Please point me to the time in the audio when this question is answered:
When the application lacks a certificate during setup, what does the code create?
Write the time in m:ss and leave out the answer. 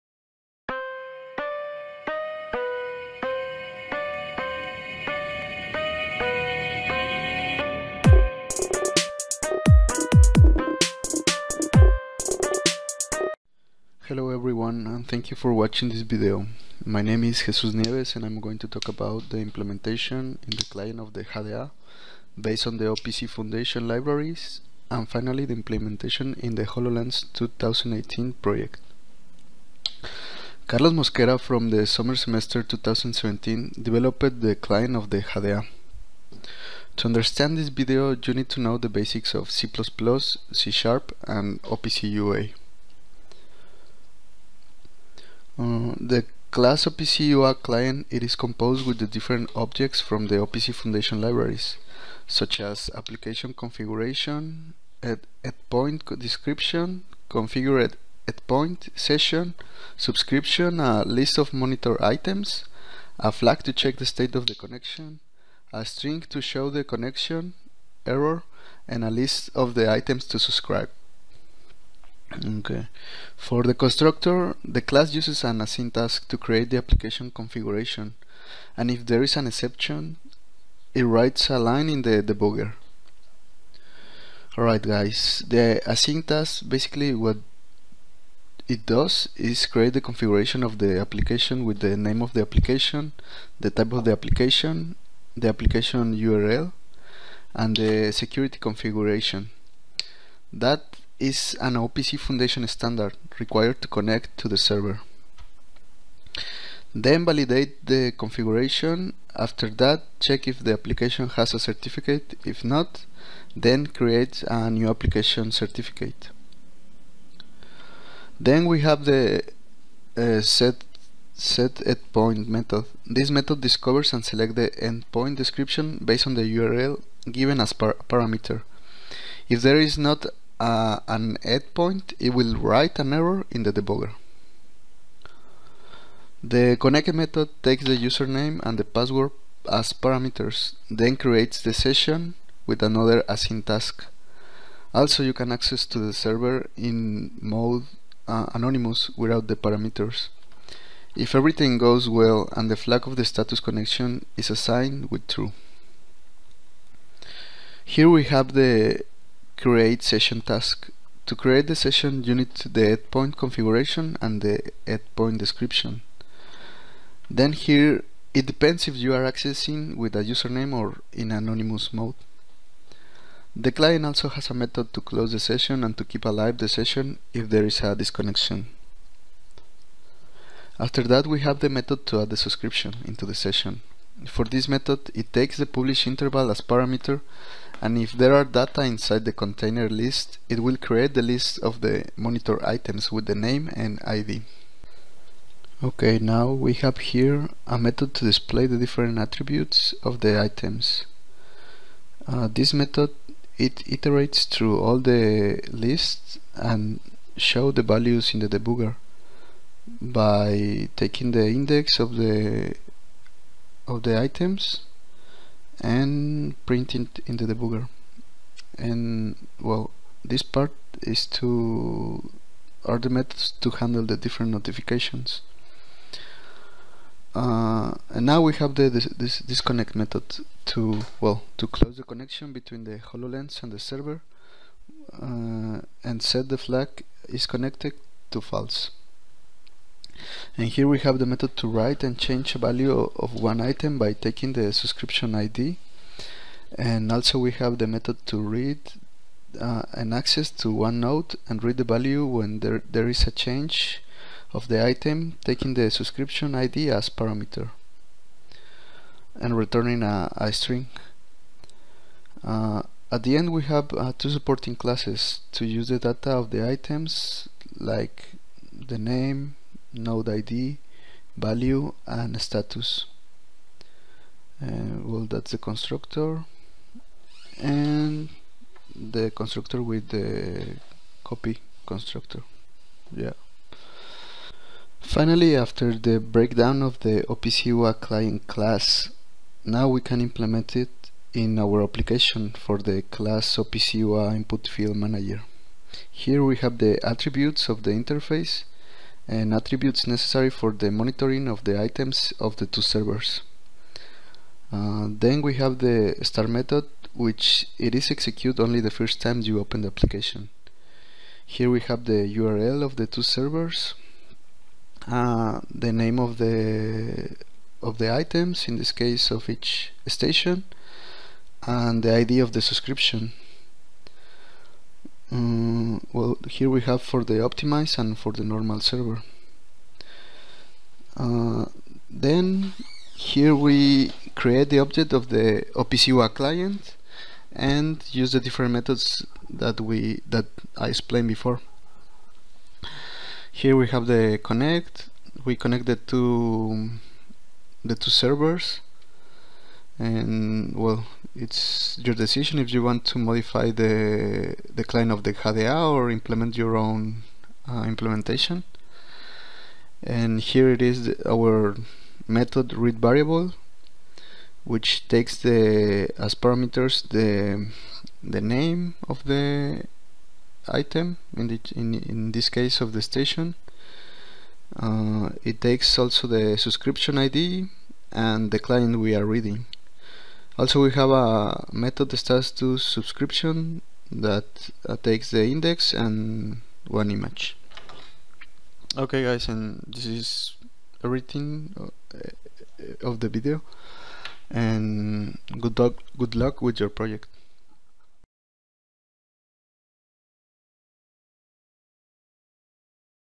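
1:54.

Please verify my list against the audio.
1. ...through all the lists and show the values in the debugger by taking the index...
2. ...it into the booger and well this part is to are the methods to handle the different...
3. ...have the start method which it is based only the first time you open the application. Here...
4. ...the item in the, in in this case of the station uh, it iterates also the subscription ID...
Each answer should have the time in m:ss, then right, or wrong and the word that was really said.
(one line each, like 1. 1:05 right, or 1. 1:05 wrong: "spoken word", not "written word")
1. 3:24 right
2. 3:37 right
3. 5:05 wrong: "executed", not "based"
4. 6:09 wrong: "takes", not "iterates".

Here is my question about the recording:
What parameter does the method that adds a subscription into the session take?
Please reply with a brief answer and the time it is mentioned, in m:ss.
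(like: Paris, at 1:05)
Publish interval, at 3:05.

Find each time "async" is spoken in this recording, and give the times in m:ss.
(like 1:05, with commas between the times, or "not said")
1:15, 1:25, 2:23.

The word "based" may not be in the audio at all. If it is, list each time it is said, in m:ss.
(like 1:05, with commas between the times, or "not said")
0:22, 2:06.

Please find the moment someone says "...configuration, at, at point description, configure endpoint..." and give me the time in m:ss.
0:53.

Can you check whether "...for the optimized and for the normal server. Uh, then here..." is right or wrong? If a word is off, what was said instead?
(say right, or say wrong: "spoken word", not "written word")
right.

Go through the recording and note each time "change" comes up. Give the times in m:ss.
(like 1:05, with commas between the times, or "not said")
4:02, 4:13.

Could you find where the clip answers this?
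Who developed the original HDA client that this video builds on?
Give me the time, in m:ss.
0:30.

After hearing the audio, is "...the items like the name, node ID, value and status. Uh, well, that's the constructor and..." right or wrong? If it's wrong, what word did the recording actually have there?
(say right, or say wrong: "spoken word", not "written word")
right.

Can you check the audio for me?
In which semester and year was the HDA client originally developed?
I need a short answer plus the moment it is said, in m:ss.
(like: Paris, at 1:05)
Summer semester 2017, at 0:31.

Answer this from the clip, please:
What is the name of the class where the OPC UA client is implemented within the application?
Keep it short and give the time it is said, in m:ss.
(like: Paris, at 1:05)
OPCUA input field manager, at 4:53.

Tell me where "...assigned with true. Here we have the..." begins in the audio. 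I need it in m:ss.
2:34.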